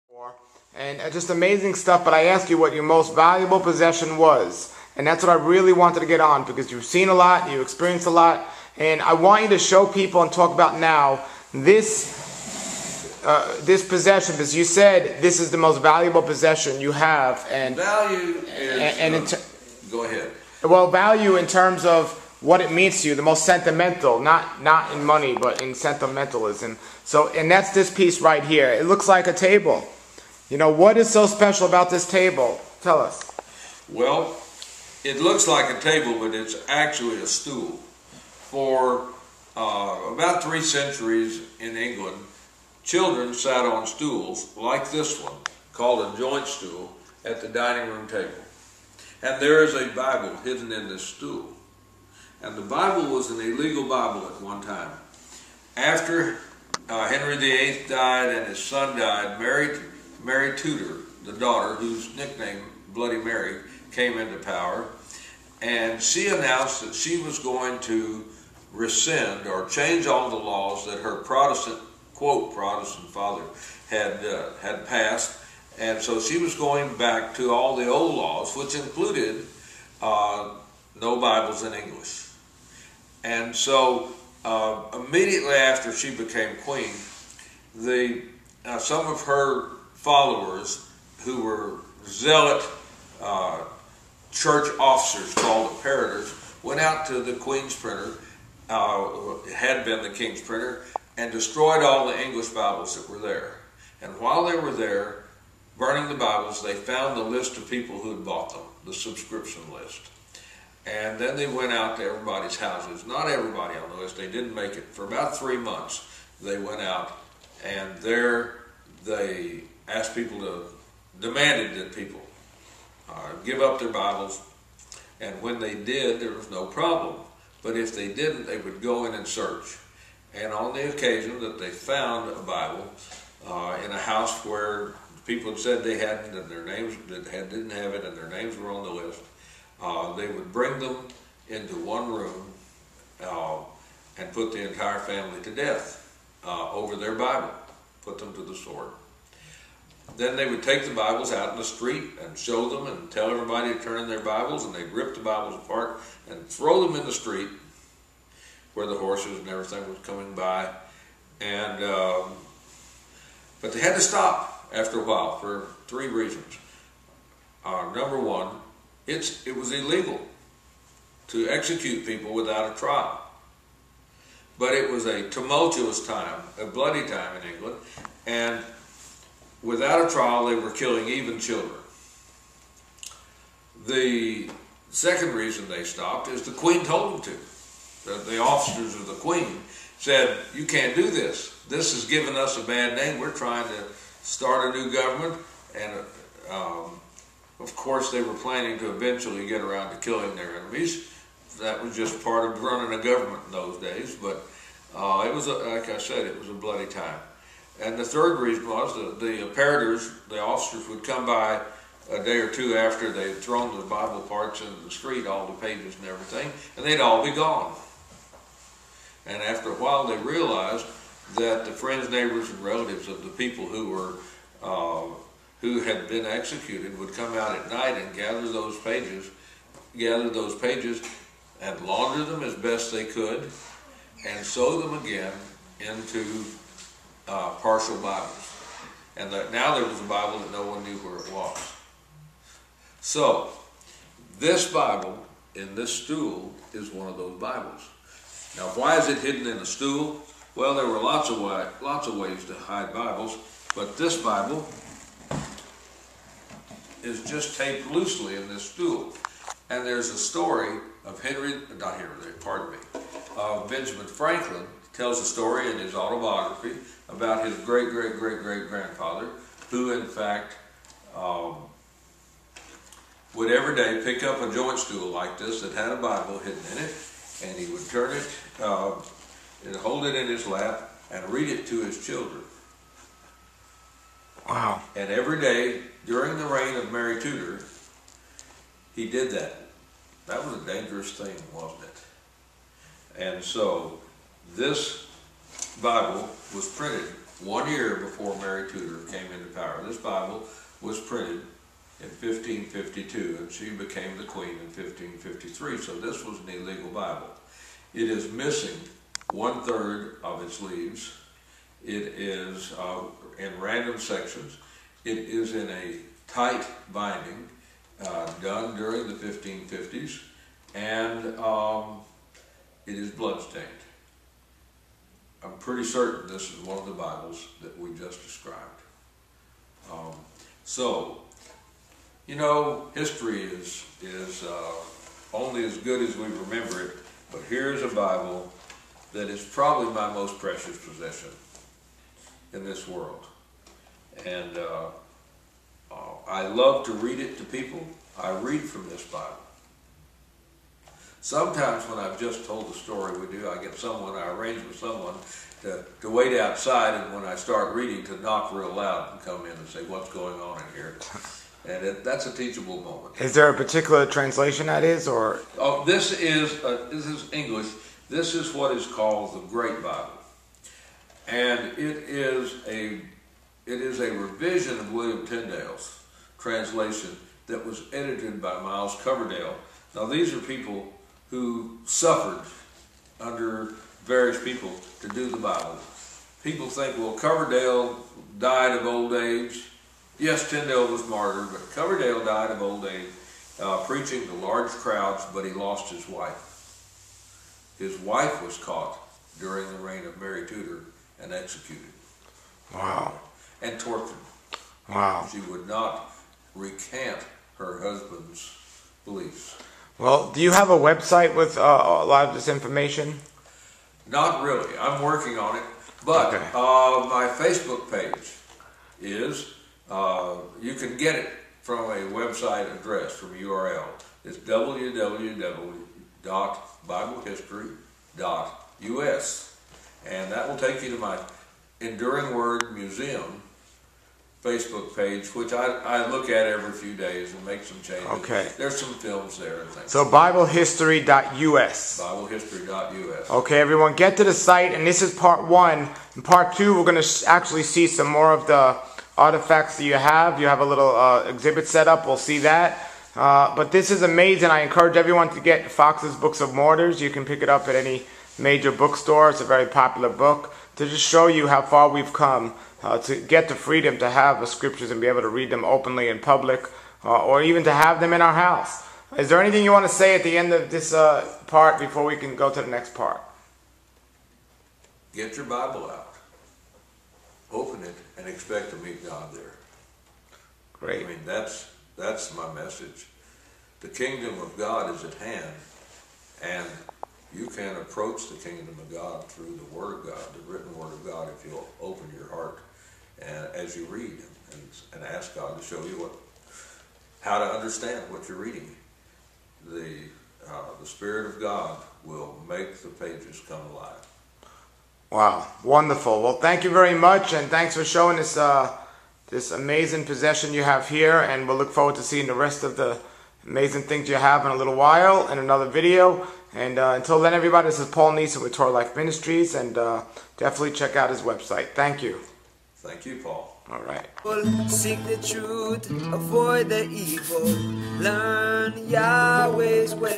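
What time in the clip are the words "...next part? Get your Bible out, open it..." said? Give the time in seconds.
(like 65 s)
472 s.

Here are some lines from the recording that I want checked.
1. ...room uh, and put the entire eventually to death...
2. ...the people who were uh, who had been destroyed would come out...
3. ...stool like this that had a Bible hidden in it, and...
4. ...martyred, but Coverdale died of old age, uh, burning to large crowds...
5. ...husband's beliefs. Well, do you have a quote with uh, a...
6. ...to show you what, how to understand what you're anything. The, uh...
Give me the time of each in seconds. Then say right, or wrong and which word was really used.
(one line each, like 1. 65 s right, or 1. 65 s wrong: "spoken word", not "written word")
1. 142 s wrong: "family", not "eventually"
2. 223 s wrong: "executed", not "destroyed"
3. 274 s right
4. 391 s wrong: "preaching", not "burning"
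5. 407 s wrong: "website", not "quote"
6. 495 s wrong: "reading", not "anything".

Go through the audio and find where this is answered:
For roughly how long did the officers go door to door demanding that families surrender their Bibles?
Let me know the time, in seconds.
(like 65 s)
115 s.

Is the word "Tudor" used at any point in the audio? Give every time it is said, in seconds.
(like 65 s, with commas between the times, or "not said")
60 s, 287 s, 298 s, 400 s.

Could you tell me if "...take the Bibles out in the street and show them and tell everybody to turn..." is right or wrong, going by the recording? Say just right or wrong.
right.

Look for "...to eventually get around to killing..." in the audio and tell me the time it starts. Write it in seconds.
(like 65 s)
198 s.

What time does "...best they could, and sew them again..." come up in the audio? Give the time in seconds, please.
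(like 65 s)
232 s.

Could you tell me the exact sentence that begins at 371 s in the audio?
And it is a, it is a revision of William Tyndale's translation that was edited by Miles Coverdale.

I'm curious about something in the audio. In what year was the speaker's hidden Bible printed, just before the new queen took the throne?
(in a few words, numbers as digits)
1552.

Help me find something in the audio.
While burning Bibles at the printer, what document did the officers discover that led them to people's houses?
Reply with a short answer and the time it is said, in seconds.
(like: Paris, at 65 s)
subscription list, at 108 s.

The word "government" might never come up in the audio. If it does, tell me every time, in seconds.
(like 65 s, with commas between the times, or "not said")
194 s, 203 s.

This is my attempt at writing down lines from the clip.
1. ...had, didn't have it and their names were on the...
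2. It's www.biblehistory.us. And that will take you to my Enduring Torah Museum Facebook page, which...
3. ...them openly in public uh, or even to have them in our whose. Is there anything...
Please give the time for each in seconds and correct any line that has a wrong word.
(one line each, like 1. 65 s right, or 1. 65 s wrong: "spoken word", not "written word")
1. 137 s right
2. 424 s wrong: "Word", not "Torah"
3. 465 s wrong: "house", not "whose".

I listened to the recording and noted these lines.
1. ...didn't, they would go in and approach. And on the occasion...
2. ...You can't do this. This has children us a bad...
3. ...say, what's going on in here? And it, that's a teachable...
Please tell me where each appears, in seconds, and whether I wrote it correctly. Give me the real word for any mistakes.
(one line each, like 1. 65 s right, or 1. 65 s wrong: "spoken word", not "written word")
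1. 128 s wrong: "search", not "approach"
2. 190 s wrong: "given", not "children"
3. 359 s right.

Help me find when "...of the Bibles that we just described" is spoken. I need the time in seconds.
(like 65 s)
326 s.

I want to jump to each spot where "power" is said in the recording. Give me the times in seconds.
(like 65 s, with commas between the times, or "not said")
64 s, 299 s.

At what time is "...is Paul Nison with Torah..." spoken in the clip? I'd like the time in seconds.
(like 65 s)
517 s.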